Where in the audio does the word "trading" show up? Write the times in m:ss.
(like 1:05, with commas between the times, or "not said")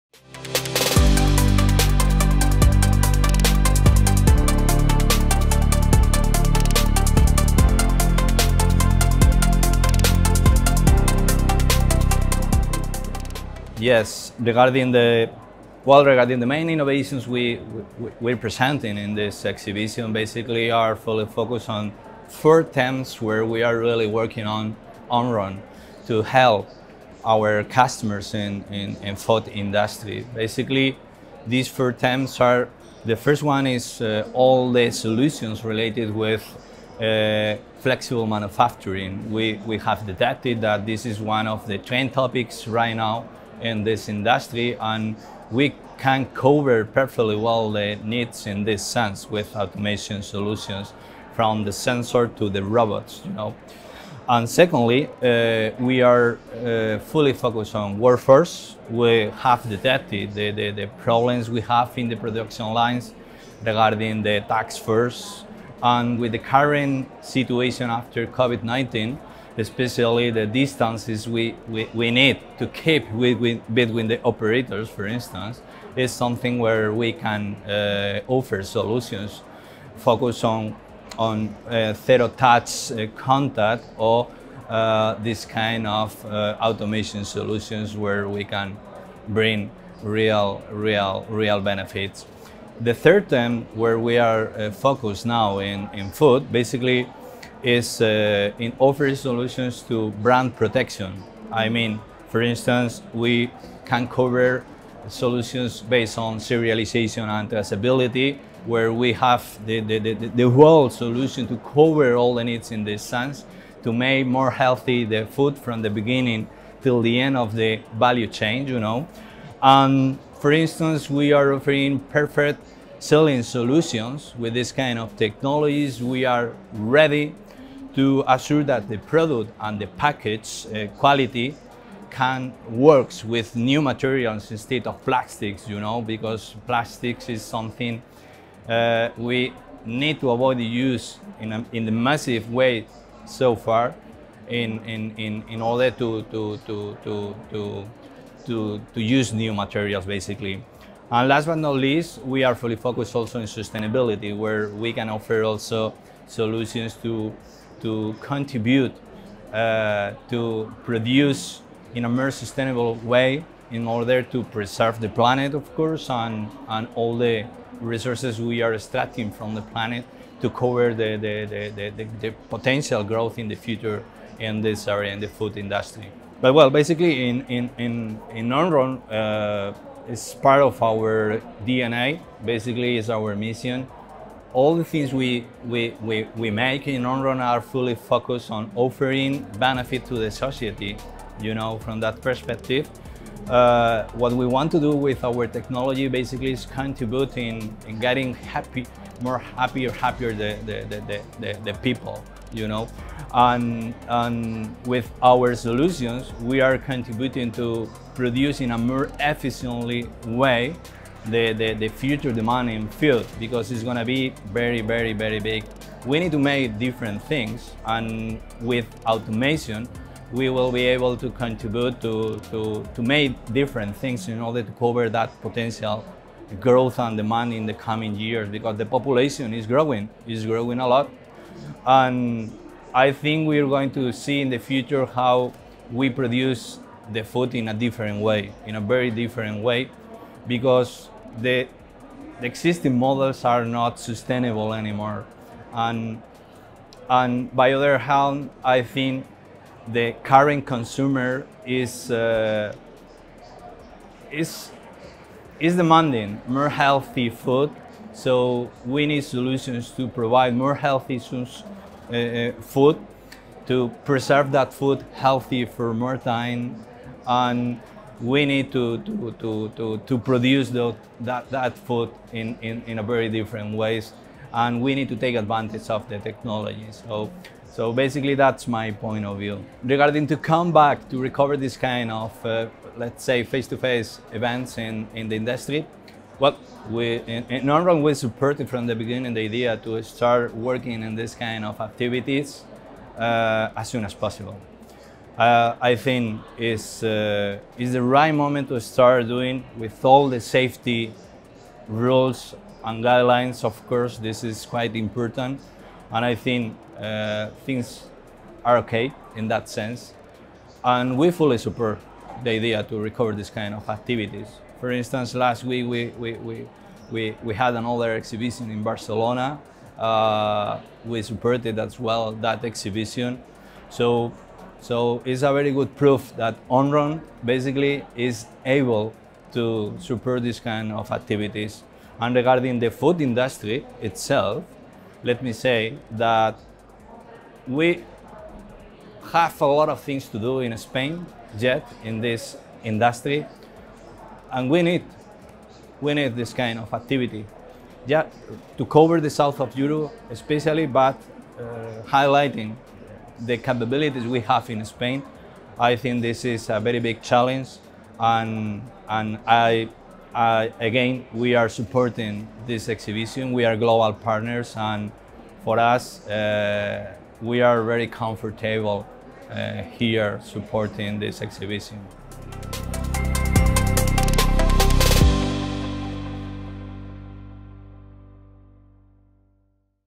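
not said.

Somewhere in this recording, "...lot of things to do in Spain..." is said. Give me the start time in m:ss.
5:39.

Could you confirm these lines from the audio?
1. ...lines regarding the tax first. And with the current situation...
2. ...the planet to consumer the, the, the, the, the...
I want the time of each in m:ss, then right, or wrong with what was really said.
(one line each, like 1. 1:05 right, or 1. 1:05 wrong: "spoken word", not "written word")
1. 1:02 right
2. 2:49 wrong: "cover", not "consumer".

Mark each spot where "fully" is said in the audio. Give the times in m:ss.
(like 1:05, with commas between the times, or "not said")
0:20, 0:56, 2:32, 3:07, 5:11.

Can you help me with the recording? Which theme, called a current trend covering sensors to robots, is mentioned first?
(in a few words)
Flexible manufacturing.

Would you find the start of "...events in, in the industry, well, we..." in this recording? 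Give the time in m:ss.
4:44.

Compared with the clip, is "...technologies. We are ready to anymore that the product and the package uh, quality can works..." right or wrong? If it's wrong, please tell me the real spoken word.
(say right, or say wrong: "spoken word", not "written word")
wrong: "assure", not "anymore".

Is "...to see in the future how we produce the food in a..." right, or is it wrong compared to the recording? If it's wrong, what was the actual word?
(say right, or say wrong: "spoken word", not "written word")
right.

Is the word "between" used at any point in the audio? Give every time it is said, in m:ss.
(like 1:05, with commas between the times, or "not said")
1:13.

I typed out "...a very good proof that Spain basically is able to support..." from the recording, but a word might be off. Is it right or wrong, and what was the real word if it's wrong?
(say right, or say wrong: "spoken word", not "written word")
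wrong: "Omron", not "Spain".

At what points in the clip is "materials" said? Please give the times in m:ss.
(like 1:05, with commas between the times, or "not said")
2:13, 2:29.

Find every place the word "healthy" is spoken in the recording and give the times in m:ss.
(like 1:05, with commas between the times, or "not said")
1:54, 4:16, 4:20, 4:25.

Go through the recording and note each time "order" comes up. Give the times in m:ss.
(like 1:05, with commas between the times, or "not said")
2:25, 2:43, 3:44.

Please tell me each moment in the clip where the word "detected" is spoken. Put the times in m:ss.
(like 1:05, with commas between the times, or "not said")
0:40, 0:59.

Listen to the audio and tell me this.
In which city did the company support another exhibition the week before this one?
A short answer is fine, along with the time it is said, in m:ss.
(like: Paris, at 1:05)
Barcelona, at 5:18.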